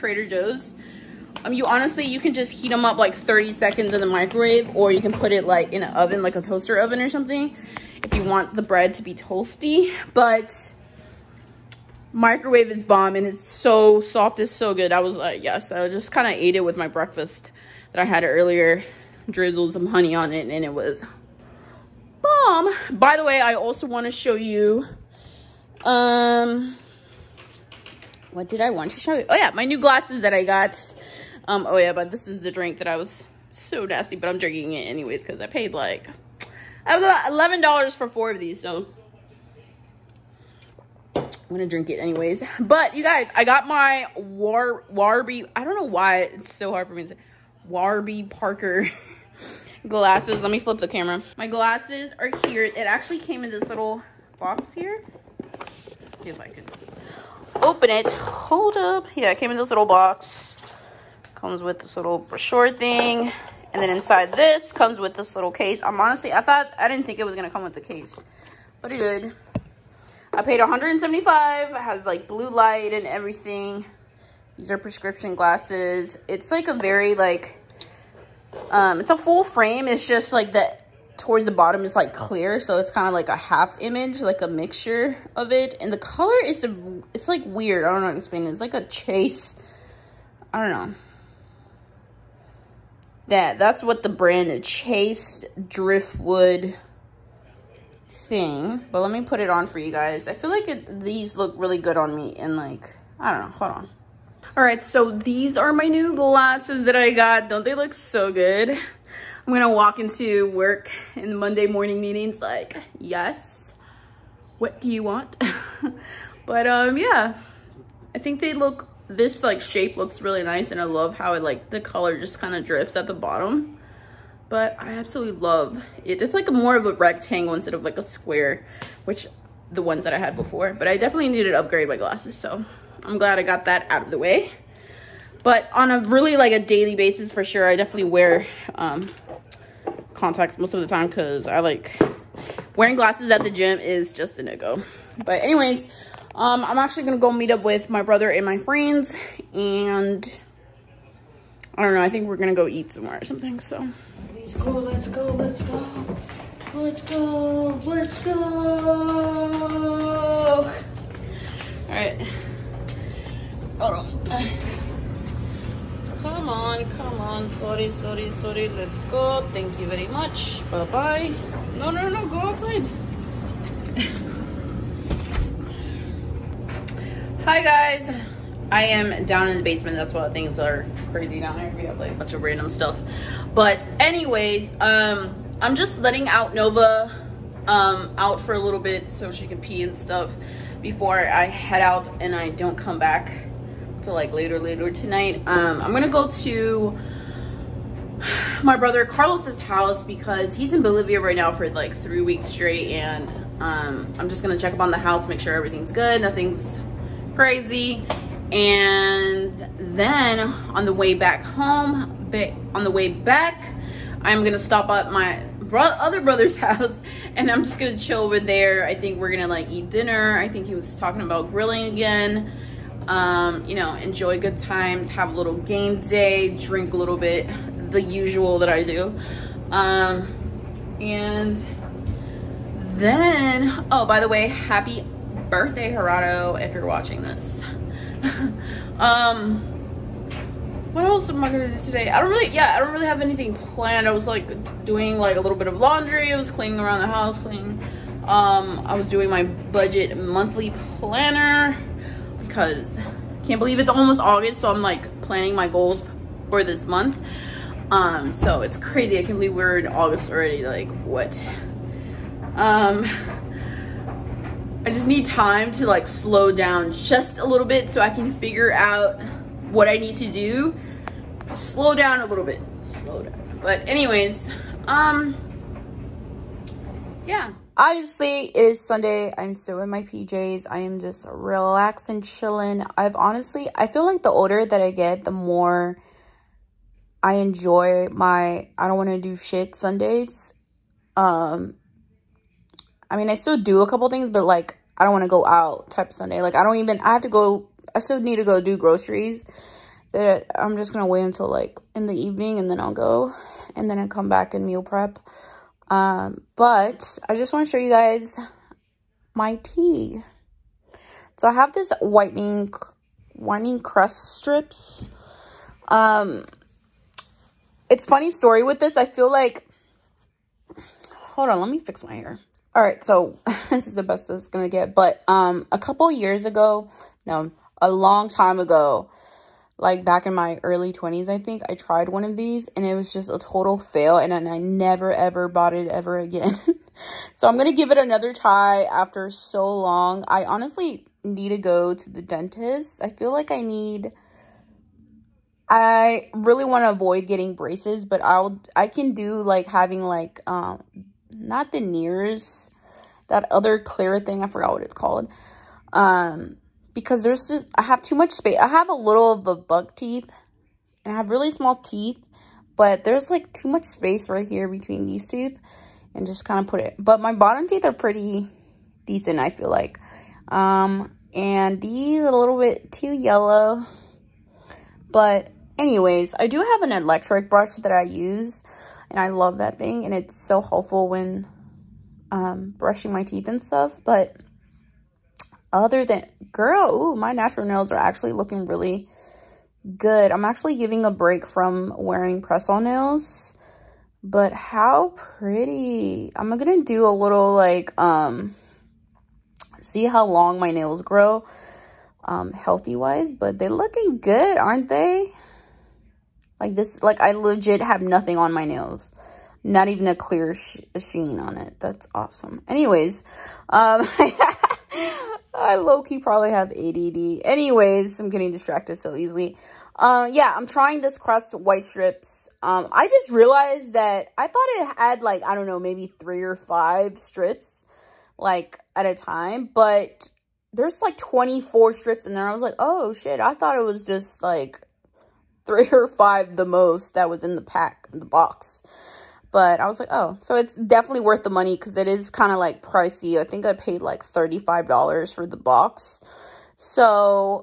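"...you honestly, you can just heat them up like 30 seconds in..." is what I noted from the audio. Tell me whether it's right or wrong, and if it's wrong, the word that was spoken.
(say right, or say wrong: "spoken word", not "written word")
right.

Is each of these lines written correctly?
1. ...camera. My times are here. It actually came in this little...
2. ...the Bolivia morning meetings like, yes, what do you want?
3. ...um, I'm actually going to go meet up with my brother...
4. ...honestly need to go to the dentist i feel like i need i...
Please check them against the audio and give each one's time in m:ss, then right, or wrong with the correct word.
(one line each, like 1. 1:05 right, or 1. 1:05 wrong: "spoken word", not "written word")
1. 0:50 wrong: "glasses", not "times"
2. 1:51 wrong: "Monday", not "Bolivia"
3. 2:26 right
4. 5:40 right.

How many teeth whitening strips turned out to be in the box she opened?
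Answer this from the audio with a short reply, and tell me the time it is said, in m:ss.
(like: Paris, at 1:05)
24, at 7:11.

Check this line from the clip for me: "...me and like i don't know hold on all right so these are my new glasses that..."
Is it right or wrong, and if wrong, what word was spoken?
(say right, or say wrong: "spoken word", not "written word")
right.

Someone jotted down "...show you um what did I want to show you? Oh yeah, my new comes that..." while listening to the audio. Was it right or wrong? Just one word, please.
wrong.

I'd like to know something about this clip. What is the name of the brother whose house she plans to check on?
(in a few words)
Carlos.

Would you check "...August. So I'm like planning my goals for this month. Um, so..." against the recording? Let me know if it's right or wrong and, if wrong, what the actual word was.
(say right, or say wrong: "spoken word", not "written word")
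right.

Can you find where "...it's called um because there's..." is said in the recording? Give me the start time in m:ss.
5:54.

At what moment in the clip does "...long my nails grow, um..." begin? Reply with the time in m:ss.
6:40.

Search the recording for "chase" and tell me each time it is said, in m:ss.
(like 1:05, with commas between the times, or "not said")
1:28, 1:34.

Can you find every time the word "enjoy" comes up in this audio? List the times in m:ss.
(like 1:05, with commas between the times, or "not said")
3:43, 4:47.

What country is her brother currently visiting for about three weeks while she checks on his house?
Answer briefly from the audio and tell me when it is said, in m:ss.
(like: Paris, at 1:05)
Bolivia, at 3:20.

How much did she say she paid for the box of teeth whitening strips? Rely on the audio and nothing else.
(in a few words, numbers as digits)
$35.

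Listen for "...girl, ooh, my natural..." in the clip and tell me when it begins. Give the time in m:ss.
6:26.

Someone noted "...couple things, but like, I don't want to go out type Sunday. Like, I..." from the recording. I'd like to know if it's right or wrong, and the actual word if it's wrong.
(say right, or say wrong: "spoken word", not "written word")
right.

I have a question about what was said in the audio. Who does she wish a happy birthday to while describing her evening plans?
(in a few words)
Gerardo.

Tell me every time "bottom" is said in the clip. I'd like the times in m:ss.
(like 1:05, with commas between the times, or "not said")
1:21, 2:03, 6:07.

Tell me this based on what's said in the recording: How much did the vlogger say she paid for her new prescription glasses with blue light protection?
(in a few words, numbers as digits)
$175.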